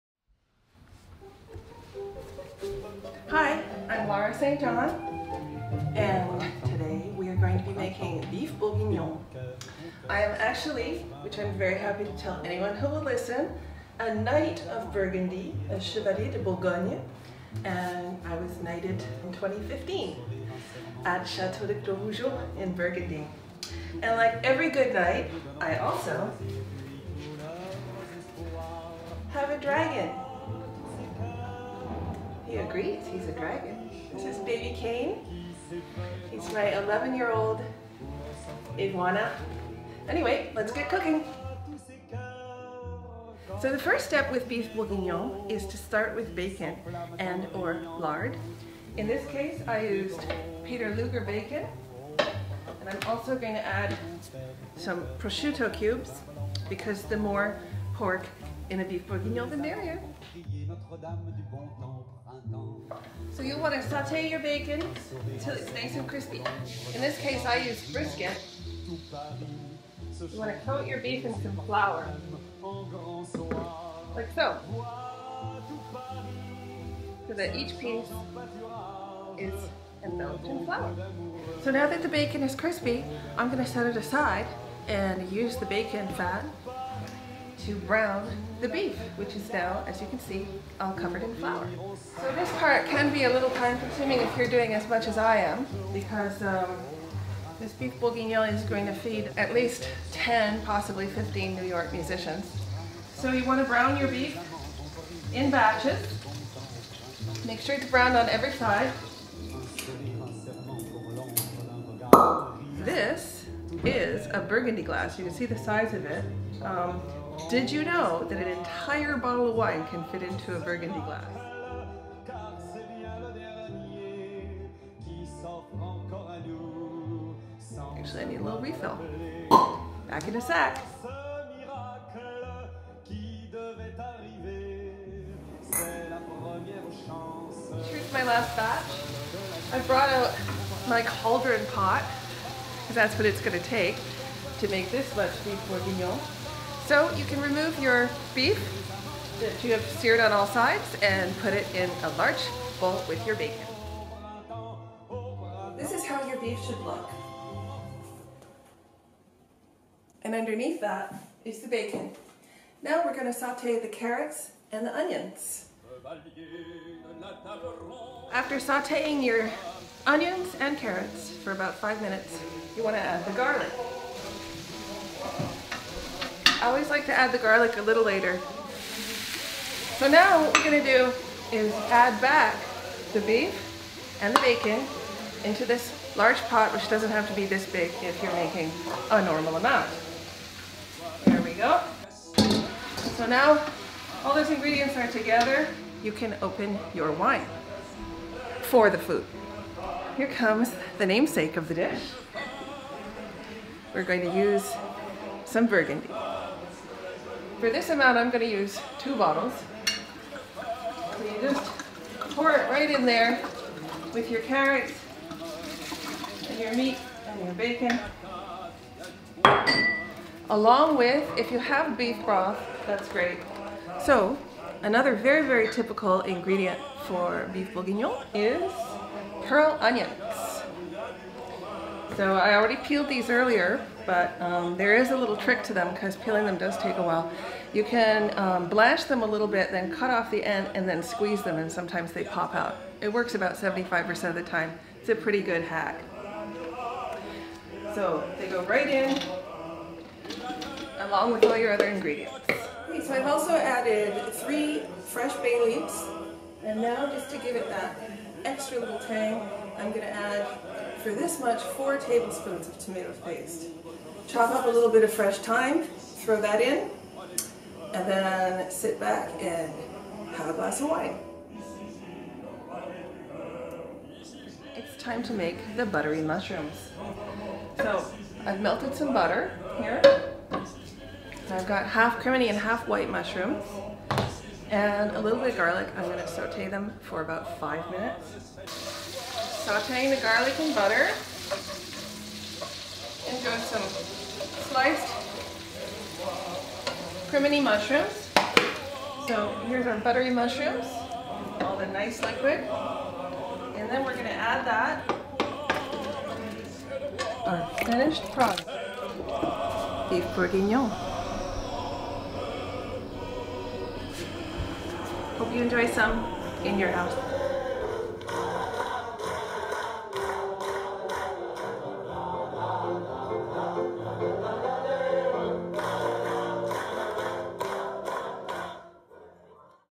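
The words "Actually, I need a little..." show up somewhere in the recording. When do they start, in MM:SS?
02:07.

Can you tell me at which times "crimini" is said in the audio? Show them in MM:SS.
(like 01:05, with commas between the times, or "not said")
04:42, 04:57.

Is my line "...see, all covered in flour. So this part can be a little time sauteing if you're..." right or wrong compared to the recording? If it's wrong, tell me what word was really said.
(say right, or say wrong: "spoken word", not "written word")
wrong: "consuming", not "sauteing".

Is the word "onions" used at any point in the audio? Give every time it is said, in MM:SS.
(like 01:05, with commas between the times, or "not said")
02:44, 02:50, 03:49.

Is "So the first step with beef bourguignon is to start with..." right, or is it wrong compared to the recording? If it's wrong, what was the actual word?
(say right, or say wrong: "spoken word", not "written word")
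right.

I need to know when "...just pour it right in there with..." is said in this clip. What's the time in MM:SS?
03:31.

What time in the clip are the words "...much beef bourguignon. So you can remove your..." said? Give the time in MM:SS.
02:25.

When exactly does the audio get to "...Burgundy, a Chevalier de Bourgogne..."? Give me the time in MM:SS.
00:14.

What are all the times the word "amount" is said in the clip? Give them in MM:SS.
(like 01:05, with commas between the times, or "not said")
03:09, 03:27.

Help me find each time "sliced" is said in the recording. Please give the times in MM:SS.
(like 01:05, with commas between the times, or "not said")
04:54.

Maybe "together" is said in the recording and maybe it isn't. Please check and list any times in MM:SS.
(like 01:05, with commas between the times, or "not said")
03:15.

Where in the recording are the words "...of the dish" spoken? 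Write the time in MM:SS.
03:21.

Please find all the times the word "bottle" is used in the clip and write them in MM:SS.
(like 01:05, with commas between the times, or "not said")
01:59, 03:29.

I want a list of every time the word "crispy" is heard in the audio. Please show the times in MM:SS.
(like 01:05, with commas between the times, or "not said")
01:06, 01:22.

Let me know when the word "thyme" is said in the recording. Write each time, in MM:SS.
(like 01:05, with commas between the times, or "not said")
04:25.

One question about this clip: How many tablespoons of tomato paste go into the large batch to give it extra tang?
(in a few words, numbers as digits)
4.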